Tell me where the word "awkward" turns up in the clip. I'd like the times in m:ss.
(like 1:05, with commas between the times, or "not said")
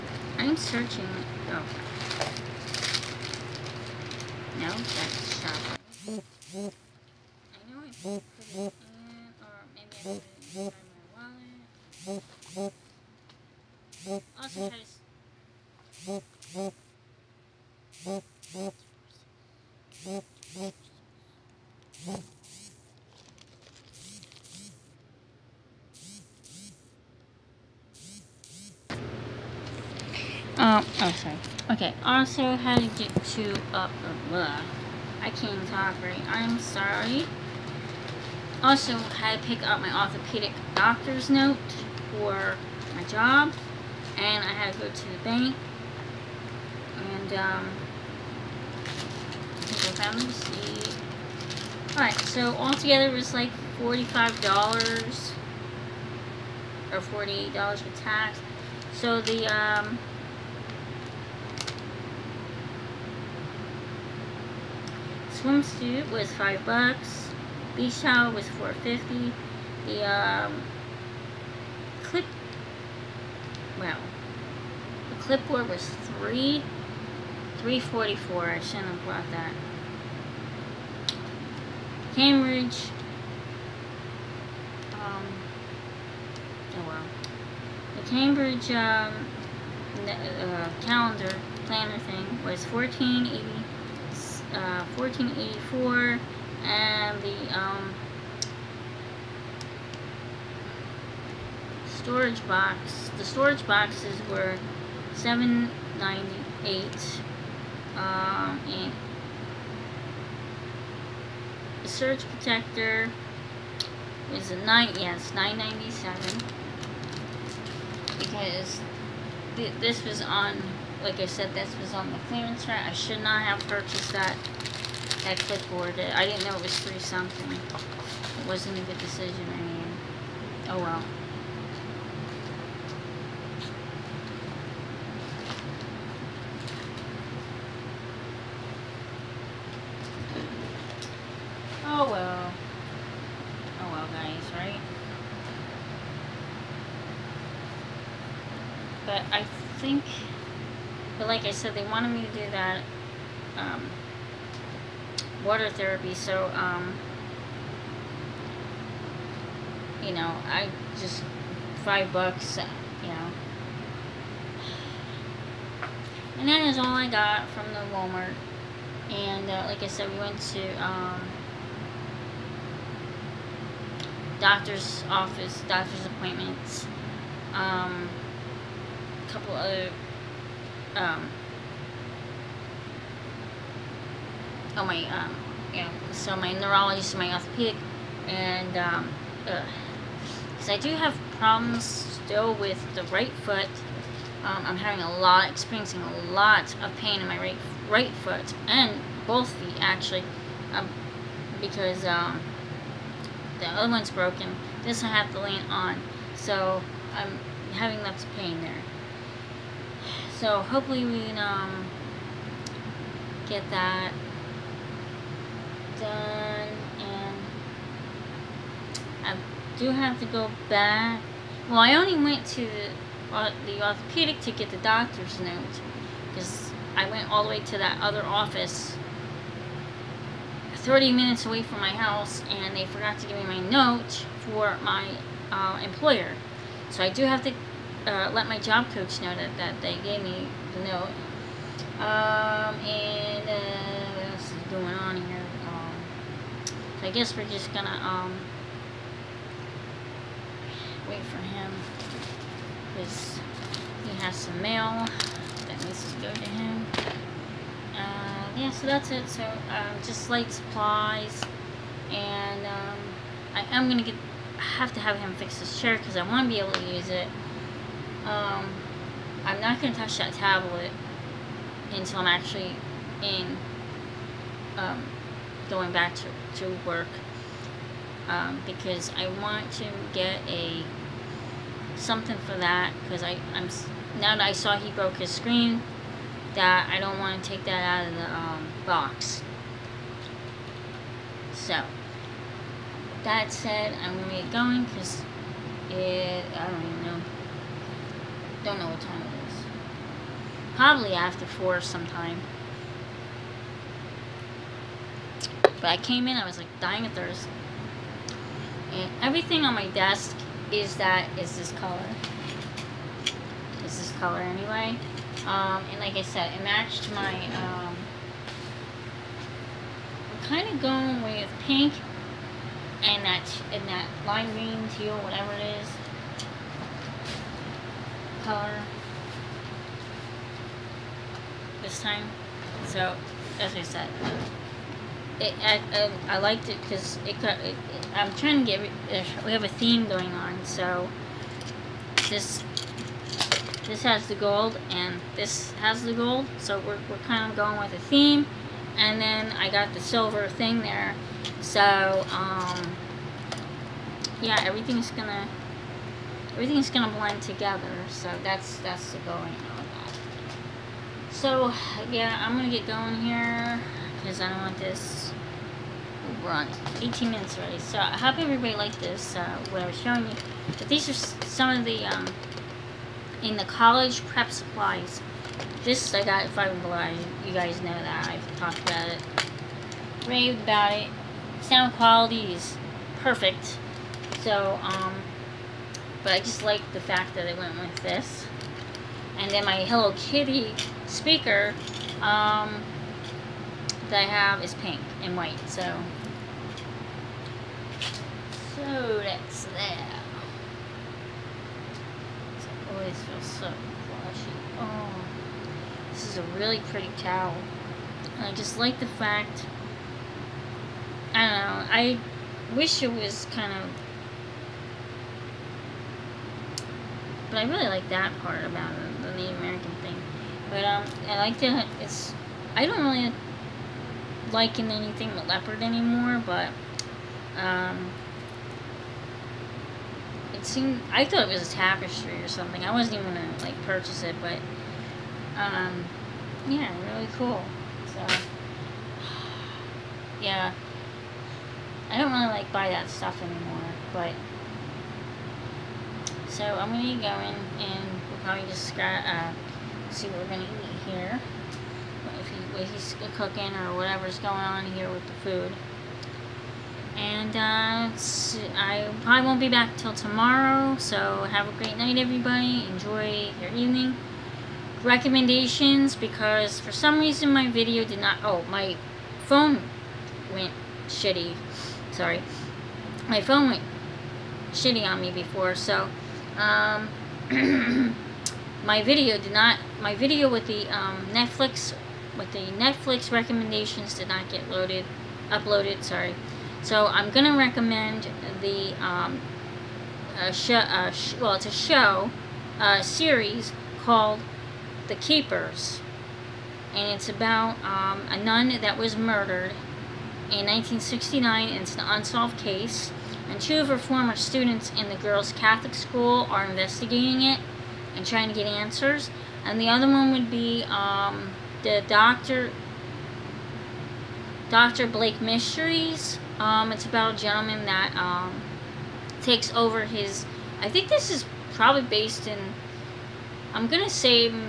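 not said.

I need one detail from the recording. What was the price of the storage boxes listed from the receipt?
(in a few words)
$7.98.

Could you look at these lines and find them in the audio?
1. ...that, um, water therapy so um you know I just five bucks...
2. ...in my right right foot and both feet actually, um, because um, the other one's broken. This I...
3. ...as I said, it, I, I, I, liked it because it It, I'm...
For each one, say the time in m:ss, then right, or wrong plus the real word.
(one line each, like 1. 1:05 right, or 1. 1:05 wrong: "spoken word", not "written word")
1. 2:32 right
2. 3:17 right
3. 5:33 right.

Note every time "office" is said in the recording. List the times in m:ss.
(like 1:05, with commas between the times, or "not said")
2:55, 3:48.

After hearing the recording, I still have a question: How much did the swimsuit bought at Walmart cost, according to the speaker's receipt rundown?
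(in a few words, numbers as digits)
$5.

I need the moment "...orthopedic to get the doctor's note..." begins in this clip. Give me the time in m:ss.
3:43.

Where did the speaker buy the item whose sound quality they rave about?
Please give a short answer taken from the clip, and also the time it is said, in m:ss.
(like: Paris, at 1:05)
5 and below, at 6:16.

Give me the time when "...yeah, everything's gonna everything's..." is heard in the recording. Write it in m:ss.
5:54.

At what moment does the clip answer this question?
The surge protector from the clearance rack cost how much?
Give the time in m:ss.
1:55.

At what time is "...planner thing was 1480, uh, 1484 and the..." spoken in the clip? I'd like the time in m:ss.
1:31.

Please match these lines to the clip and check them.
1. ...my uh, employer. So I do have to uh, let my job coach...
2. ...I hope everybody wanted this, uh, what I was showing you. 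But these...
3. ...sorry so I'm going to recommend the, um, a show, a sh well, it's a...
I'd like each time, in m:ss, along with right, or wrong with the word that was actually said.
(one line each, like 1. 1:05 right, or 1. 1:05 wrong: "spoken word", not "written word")
1. 3:54 right
2. 6:07 wrong: "liked", not "wanted"
3. 8:06 right.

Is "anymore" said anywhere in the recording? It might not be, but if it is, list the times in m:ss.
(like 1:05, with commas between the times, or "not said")
7:05, 7:23.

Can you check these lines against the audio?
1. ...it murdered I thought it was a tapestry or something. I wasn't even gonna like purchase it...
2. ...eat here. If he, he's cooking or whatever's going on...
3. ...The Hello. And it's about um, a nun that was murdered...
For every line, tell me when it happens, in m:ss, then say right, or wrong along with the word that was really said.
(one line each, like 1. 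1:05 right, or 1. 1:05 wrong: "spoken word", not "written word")
1. 7:10 wrong: "seemed", not "murdered"
2. 7:30 right
3. 8:15 wrong: "Keepers", not "Hello".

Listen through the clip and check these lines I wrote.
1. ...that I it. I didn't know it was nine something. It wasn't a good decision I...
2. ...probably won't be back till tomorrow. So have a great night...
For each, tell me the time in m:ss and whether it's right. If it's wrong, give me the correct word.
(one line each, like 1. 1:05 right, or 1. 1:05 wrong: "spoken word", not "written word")
1. 2:04 wrong: "three", not "nine"
2. 7:39 right.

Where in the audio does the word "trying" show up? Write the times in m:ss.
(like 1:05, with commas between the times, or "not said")
5:38, 8:28.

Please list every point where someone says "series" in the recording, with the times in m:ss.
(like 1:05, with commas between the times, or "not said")
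8:13.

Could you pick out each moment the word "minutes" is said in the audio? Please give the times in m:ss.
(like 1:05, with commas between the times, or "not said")
3:51, 6:07.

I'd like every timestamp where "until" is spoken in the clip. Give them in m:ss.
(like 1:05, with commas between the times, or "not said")
4:31.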